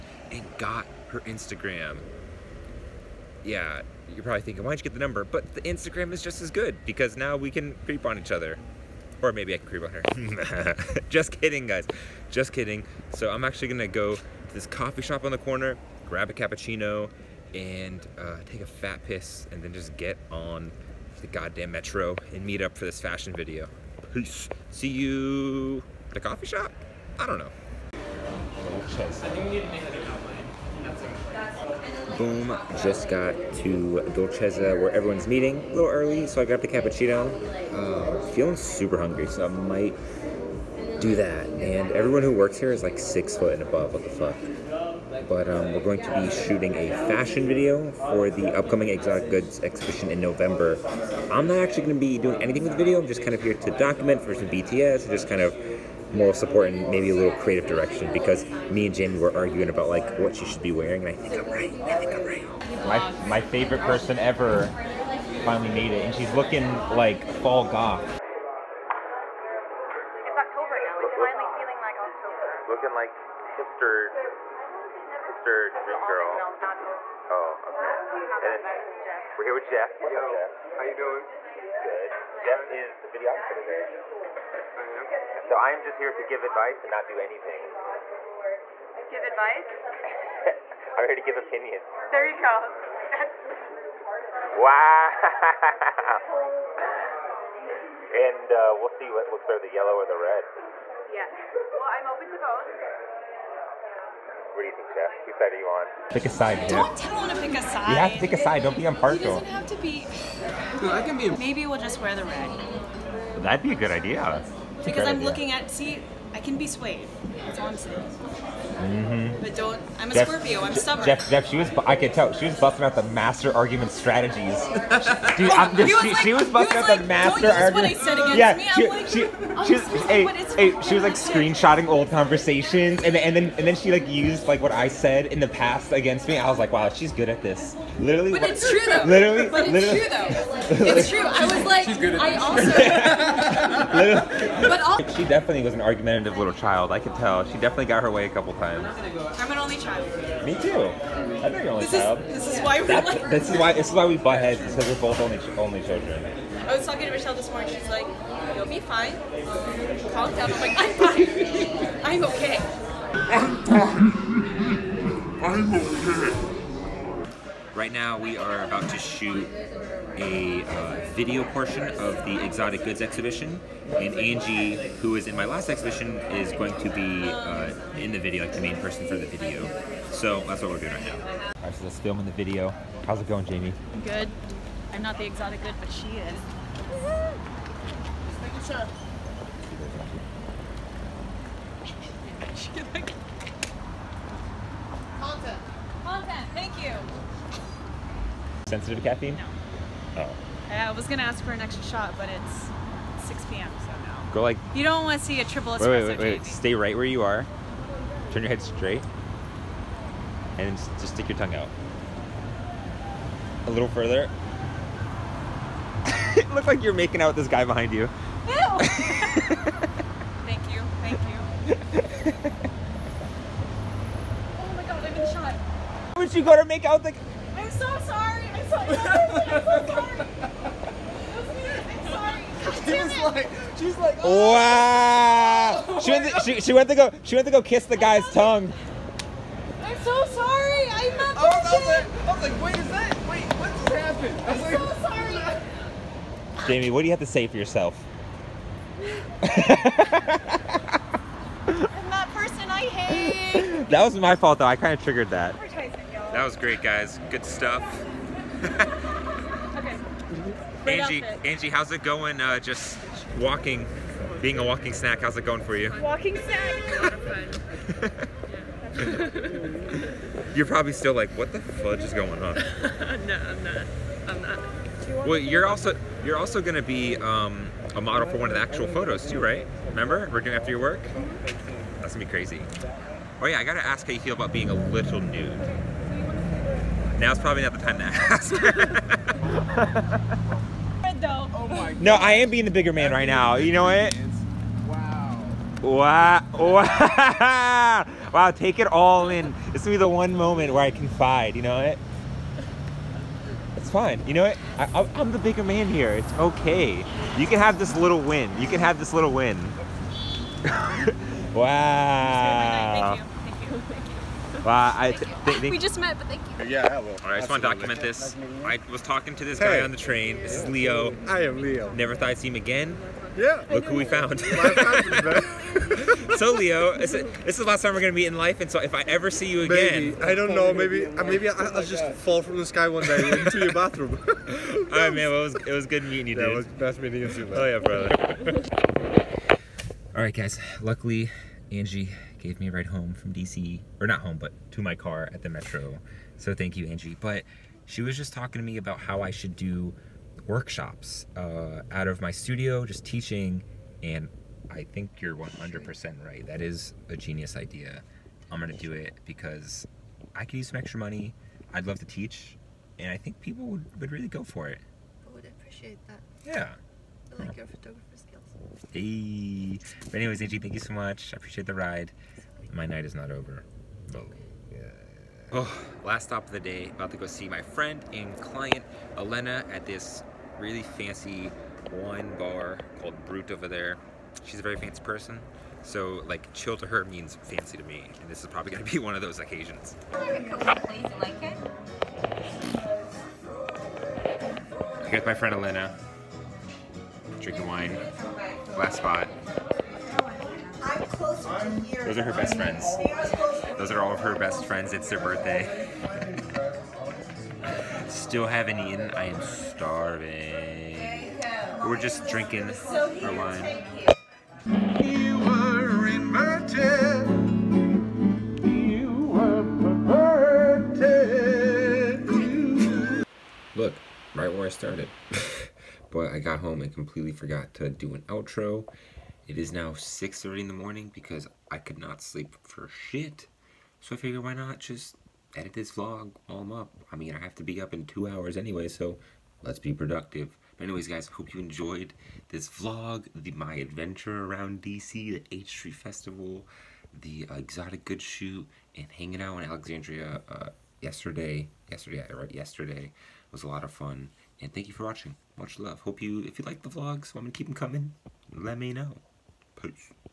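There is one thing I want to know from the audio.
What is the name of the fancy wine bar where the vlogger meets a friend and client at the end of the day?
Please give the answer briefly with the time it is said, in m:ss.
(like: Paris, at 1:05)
Brute, at 6:23.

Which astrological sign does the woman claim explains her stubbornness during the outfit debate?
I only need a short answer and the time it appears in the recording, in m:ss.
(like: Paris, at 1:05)
Scorpio, at 2:00.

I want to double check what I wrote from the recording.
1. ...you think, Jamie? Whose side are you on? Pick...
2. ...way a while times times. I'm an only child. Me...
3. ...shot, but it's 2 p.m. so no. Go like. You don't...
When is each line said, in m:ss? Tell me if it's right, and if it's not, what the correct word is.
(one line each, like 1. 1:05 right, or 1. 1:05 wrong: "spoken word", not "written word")
1. 1:44 wrong: "Jeff", not "Jamie"
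2. 2:28 wrong: "couple", not "while"
3. 3:21 wrong: "6", not "2".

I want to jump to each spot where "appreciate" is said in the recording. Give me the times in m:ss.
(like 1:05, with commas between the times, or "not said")
6:05, 6:11.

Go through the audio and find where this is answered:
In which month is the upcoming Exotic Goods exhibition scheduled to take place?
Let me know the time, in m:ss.
0:50.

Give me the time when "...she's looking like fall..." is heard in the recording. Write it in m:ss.
1:06.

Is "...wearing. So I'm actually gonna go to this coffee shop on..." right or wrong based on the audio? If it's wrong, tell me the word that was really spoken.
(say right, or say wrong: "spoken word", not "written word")
wrong: "kidding", not "wearing".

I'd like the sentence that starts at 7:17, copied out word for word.
I mean, I have to be up in two hours anyway, so let's be productive.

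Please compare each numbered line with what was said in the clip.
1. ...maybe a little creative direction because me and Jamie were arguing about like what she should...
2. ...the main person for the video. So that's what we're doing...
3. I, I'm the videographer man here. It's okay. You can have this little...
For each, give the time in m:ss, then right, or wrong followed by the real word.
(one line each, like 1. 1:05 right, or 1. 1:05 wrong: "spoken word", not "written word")
1. 0:56 right
2. 2:58 right
3. 5:04 wrong: "bigger", not "videographer".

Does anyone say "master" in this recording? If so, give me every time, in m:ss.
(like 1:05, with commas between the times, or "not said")
2:03, 2:07.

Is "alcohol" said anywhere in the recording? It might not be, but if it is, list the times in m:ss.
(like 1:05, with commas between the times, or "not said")
not said.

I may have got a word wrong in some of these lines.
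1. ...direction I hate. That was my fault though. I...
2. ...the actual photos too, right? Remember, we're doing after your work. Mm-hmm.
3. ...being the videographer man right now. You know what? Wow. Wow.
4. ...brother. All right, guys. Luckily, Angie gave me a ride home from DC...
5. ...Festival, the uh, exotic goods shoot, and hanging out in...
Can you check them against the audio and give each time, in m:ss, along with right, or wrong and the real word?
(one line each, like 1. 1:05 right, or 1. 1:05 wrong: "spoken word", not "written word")
1. 4:12 wrong: "person", not "direction"
2. 4:38 right
3. 4:52 wrong: "bigger", not "videographer"
4. 5:37 right
5. 7:25 right.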